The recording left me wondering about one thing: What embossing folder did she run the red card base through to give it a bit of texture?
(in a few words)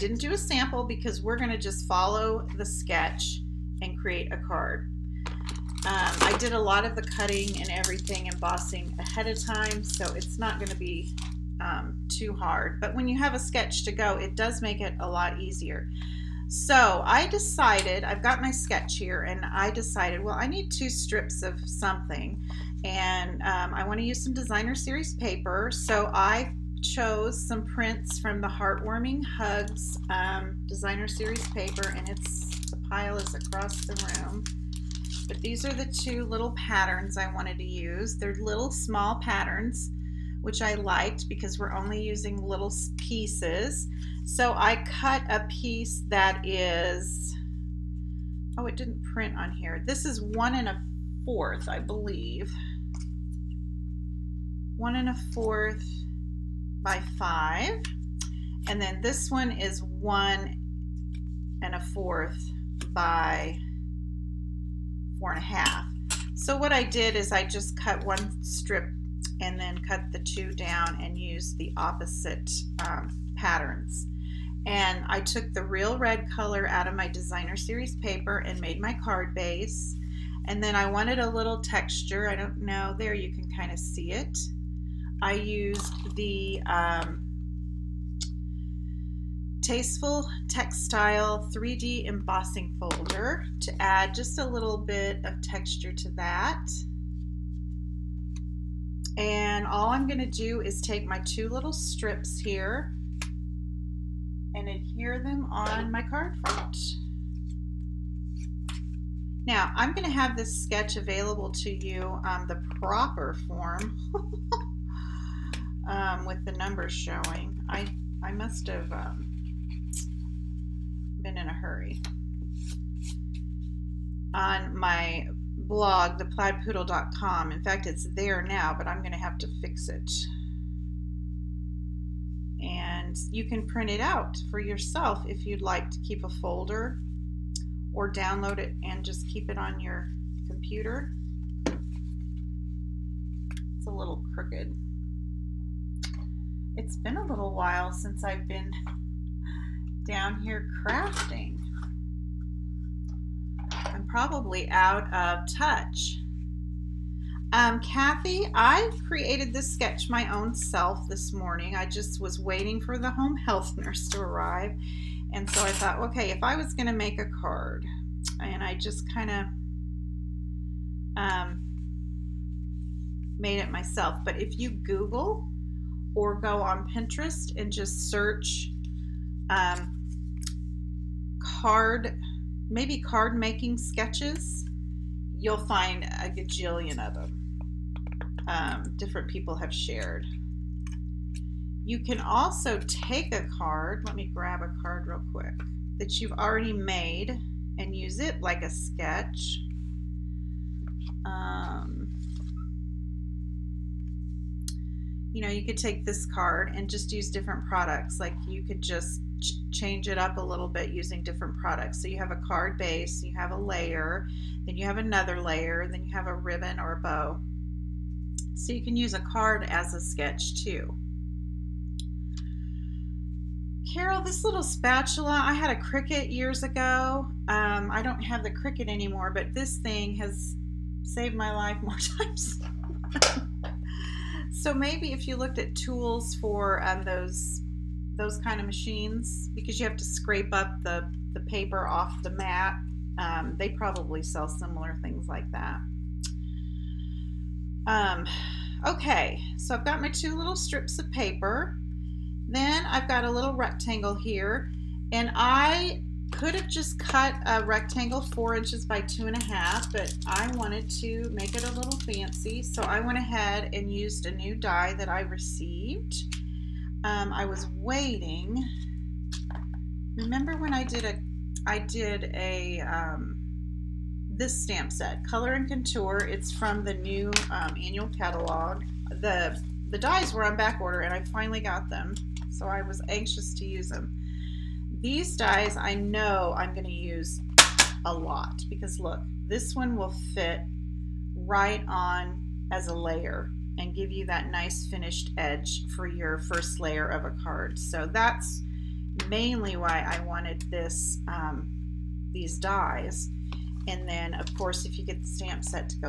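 Tasteful Textile 3D Embossing Folder.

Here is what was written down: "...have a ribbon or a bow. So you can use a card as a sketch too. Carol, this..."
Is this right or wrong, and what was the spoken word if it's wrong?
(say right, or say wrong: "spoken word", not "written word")
right.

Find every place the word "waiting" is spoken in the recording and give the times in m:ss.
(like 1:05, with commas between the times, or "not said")
2:42, 4:27.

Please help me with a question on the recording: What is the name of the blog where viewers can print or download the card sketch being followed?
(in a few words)
theplaidpoodle.com.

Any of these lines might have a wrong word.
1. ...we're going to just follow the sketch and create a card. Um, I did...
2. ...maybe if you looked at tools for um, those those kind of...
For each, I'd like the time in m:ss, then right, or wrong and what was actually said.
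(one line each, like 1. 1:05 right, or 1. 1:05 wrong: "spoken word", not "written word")
1. 0:01 right
2. 3:54 right.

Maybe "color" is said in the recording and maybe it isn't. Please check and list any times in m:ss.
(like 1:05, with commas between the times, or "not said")
1:16, 4:35.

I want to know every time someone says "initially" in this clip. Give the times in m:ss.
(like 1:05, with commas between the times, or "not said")
not said.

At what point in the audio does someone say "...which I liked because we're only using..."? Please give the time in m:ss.
0:40.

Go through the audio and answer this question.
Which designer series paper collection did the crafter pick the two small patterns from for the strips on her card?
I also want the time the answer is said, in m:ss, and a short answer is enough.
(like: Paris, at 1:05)
Heartwarming Hugs, at 0:28.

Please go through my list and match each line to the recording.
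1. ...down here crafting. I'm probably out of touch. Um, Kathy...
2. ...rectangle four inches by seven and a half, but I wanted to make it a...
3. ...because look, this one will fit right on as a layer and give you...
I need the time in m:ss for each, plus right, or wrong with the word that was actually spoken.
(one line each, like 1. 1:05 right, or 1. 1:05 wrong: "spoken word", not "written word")
1. 2:30 right
2. 4:17 wrong: "two", not "seven"
3. 4:48 right.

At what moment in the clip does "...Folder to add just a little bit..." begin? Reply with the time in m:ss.
1:32.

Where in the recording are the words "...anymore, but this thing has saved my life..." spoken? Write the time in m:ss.
3:48.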